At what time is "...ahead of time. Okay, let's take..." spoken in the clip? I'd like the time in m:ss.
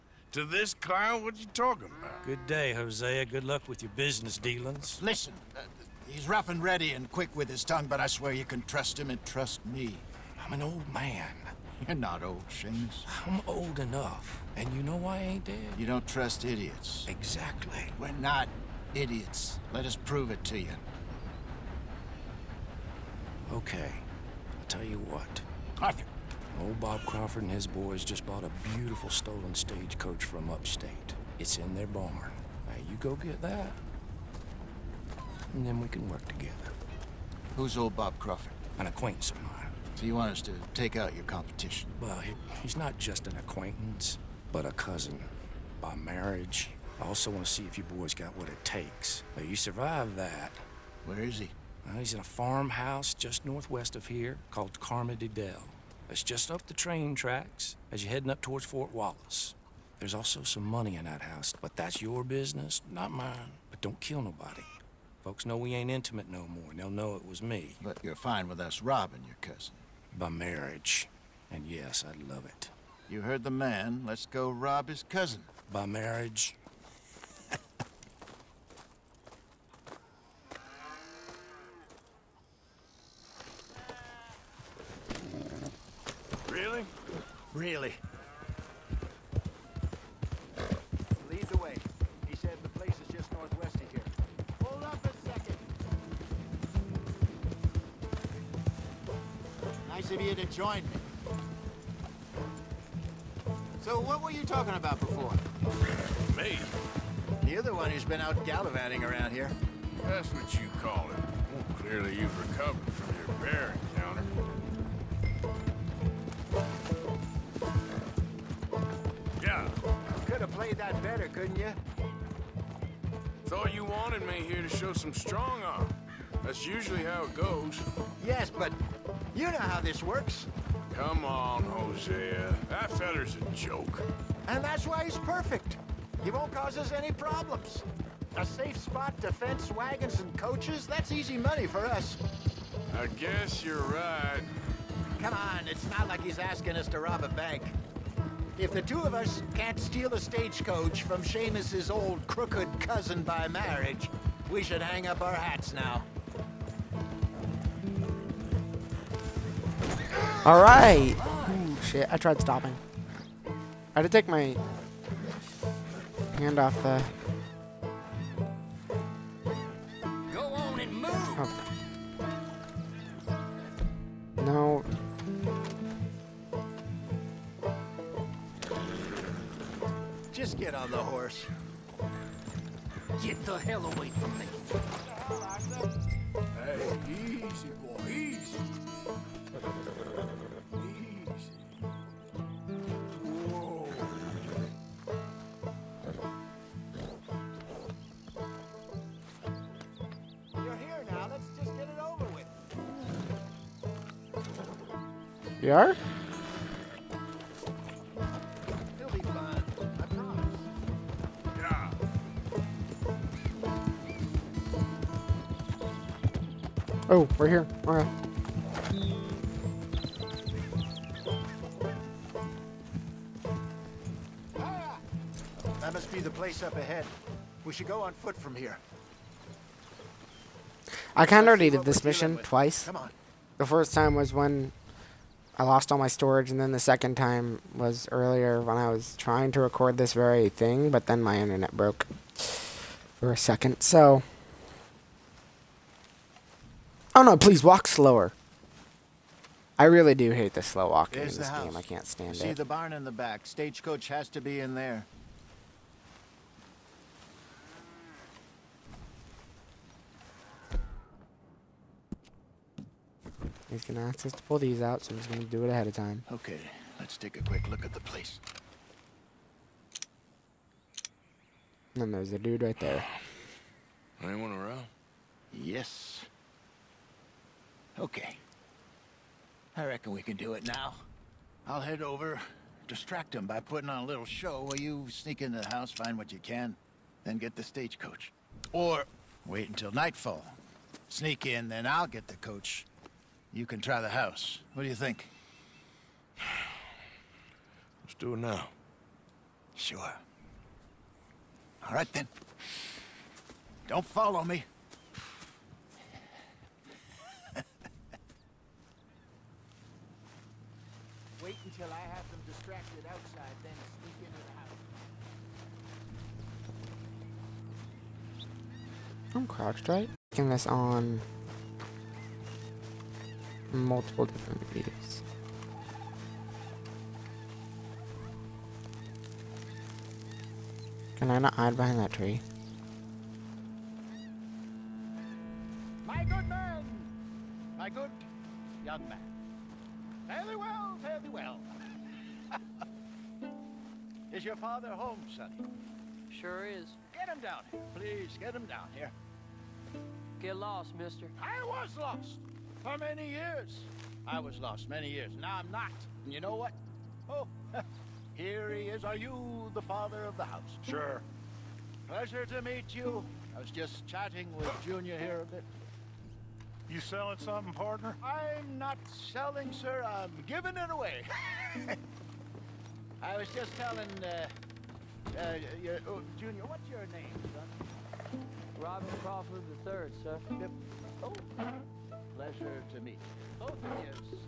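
4:25.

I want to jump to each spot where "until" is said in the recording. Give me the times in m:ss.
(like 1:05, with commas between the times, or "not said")
4:49, 5:11.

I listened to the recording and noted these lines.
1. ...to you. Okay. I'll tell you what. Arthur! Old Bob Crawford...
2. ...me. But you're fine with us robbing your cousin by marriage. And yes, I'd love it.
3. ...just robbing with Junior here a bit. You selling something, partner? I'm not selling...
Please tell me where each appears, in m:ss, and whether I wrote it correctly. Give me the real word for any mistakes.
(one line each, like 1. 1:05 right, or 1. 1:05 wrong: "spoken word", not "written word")
1. 0:20 right
2. 1:07 right
3. 6:03 wrong: "chatting", not "robbing".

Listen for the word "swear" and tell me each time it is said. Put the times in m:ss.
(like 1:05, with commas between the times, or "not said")
0:08.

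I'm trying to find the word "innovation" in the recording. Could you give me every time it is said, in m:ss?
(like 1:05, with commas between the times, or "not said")
not said.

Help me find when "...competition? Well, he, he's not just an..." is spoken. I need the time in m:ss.
0:41.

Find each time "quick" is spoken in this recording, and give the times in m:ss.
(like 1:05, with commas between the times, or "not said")
0:07, 4:27.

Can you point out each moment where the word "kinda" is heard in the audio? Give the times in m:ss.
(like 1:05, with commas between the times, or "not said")
3:51.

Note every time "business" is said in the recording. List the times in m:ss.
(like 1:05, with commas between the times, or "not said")
0:03, 1:02.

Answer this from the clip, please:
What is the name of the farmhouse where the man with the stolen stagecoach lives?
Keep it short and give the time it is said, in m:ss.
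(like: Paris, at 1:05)
Carmody Dell, at 0:54.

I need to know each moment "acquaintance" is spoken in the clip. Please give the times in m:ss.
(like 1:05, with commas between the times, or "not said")
0:38, 0:43.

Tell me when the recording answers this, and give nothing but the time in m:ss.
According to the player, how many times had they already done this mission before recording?
3:52.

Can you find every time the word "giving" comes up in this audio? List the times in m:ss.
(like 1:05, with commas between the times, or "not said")
6:10.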